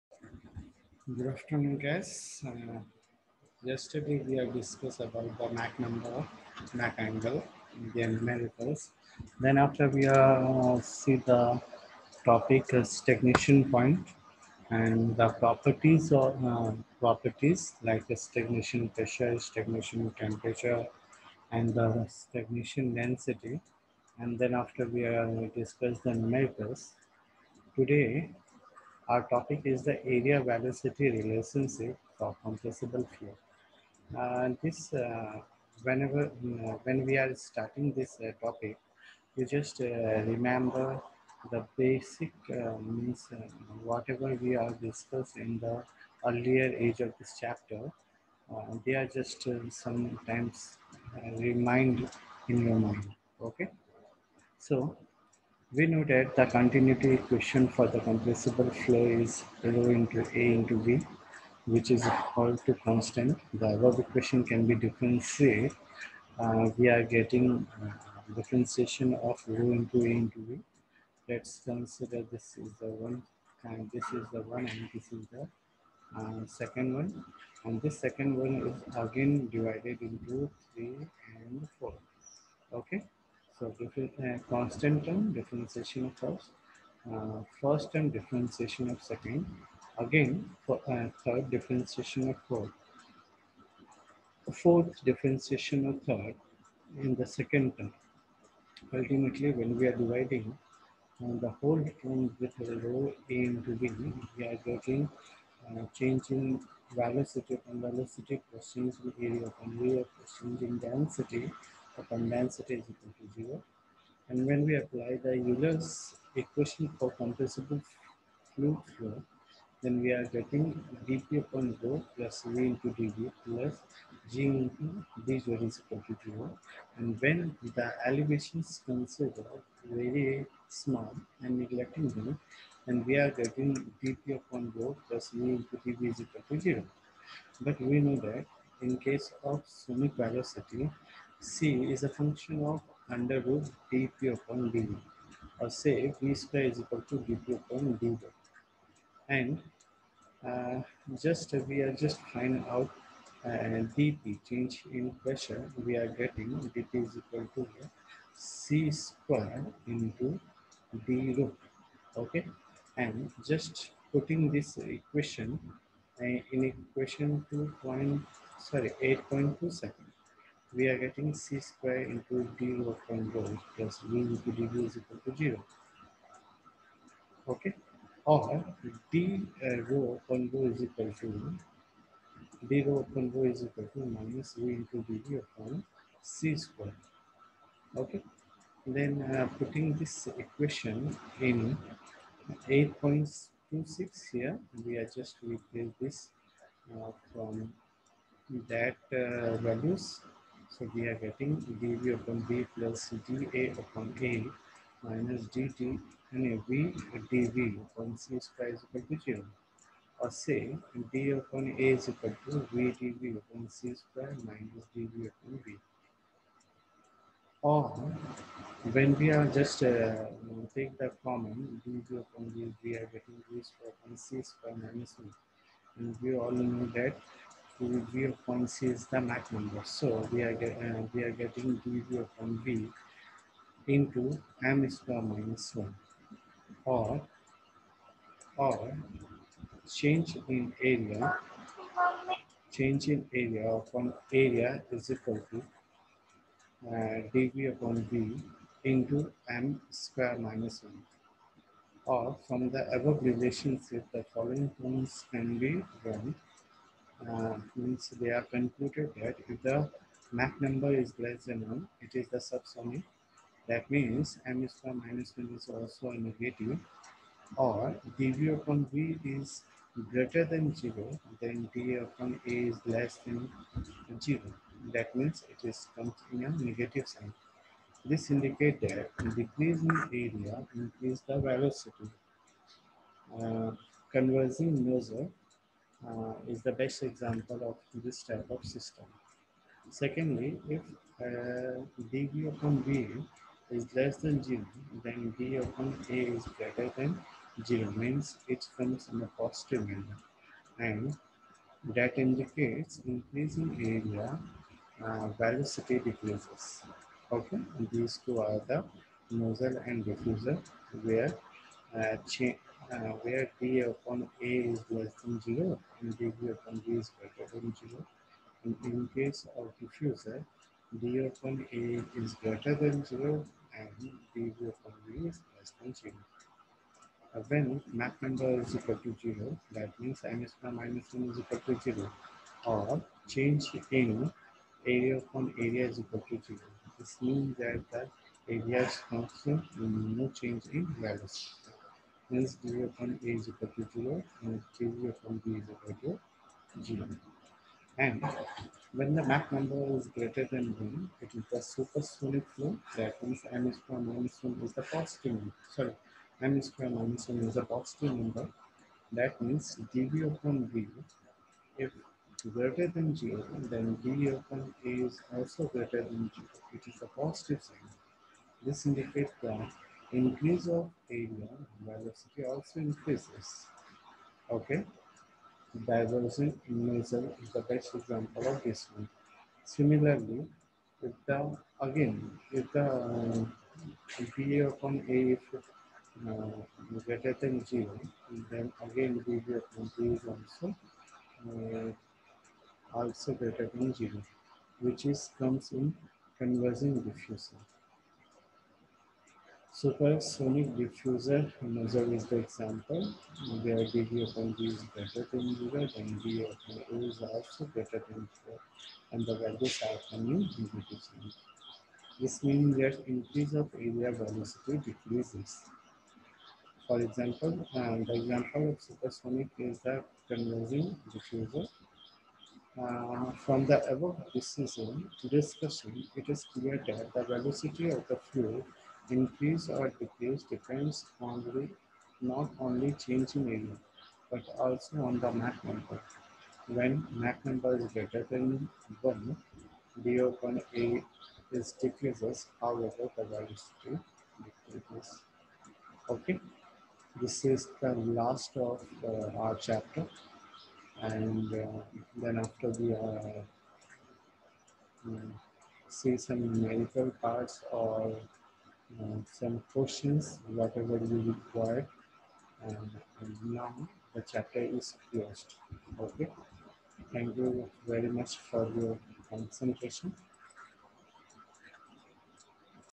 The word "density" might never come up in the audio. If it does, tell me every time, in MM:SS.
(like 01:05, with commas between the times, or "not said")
00:22, 01:50.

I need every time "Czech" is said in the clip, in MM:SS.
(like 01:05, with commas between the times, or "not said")
not said.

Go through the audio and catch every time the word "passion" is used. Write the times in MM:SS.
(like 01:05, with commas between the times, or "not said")
not said.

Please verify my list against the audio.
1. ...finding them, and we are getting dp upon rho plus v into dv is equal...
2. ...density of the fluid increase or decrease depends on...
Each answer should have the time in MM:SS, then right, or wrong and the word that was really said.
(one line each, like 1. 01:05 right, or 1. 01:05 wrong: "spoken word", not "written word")
1. 02:11 wrong: "neglecting", not "finding"
2. 07:07 wrong: "velocity", not "density".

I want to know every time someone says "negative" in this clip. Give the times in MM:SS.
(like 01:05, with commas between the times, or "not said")
04:26, 04:36.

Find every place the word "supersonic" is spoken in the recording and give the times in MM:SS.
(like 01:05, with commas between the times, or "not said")
05:51, 06:39, 06:58.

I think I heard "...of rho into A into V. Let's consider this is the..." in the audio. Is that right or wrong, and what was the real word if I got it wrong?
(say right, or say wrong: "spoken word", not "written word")
right.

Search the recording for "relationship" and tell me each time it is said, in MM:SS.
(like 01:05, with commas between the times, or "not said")
00:31, 04:13.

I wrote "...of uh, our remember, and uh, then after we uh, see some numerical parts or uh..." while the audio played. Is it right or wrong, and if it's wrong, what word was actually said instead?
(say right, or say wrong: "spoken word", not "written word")
wrong: "chapter", not "remember".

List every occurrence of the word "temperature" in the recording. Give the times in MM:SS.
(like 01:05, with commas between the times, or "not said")
00:20.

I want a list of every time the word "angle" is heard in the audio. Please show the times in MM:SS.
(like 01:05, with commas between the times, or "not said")
00:06.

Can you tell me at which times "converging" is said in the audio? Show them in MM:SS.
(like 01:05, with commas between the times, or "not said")
04:44, 06:36, 07:00.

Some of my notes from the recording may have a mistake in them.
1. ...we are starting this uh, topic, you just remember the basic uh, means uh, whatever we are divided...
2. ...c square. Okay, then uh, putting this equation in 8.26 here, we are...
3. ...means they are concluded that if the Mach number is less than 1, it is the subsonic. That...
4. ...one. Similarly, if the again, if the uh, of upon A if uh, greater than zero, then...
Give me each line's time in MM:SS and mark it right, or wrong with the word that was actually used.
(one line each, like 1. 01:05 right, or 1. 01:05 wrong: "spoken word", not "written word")
1. 00:37 wrong: "discussed", not "divided"
2. 03:06 right
3. 04:17 right
4. 06:18 right.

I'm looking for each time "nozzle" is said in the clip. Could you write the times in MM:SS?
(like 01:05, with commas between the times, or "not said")
05:09, 06:41.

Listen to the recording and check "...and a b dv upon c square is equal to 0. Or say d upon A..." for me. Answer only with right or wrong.
right.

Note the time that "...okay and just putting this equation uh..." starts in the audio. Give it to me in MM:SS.
02:42.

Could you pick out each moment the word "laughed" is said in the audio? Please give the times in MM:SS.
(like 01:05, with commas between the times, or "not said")
not said.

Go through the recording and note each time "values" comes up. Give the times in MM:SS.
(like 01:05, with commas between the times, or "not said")
03:19, 05:40, 06:49.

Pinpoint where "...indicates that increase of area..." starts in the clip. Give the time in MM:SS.
06:08.